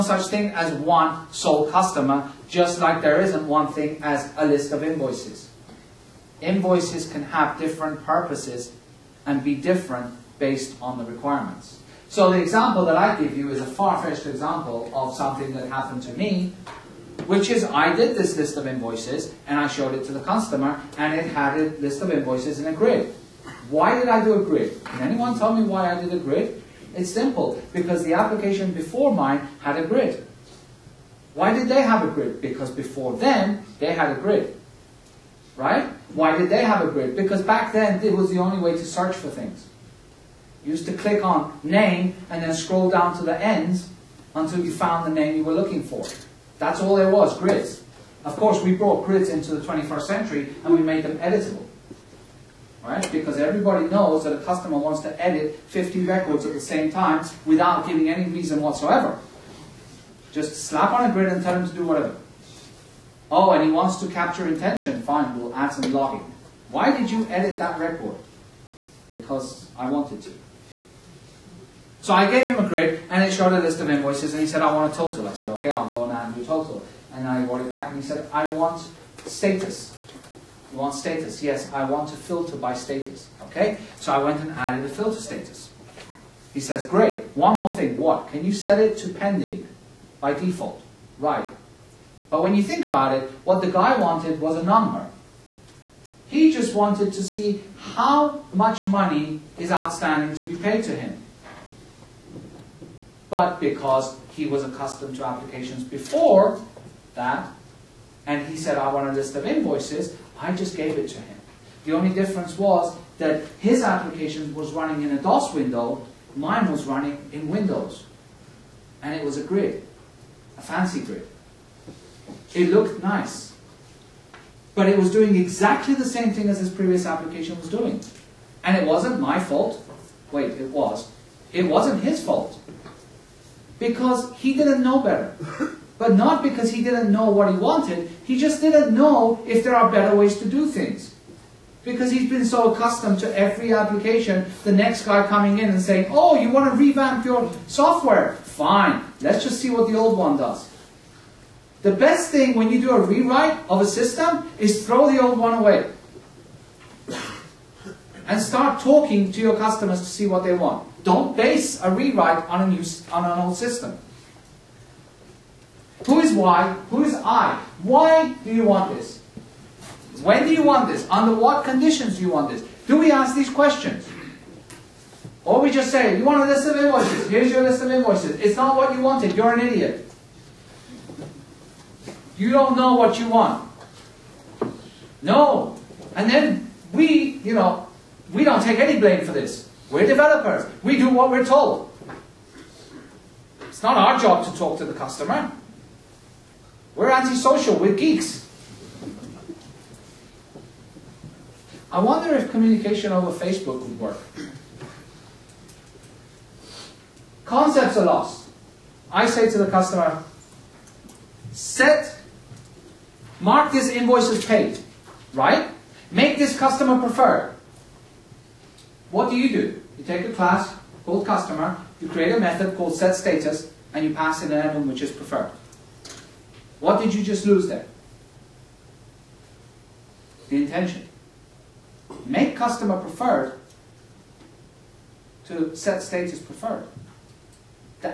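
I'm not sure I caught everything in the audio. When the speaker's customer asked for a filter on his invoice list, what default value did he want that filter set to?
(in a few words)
pending.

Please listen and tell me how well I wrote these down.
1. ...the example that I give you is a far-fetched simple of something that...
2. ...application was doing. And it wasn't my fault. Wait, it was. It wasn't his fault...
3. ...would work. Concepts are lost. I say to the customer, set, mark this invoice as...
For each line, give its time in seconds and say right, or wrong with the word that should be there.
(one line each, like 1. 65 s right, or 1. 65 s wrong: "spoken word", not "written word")
1. 12 s wrong: "example", not "simple"
2. 127 s right
3. 203 s right.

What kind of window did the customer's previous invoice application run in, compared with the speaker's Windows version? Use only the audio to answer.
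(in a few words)
DOS window.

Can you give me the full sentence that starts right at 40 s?
You used to click on name and then scroll down to the ends until you found the name you were looking for.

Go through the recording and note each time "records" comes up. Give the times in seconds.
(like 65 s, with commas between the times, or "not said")
56 s, 67 s.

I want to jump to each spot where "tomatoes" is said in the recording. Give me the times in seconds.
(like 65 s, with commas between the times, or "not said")
not said.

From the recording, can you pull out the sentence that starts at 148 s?
Fine, let's just see what the old one does.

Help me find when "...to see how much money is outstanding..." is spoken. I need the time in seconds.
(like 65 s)
97 s.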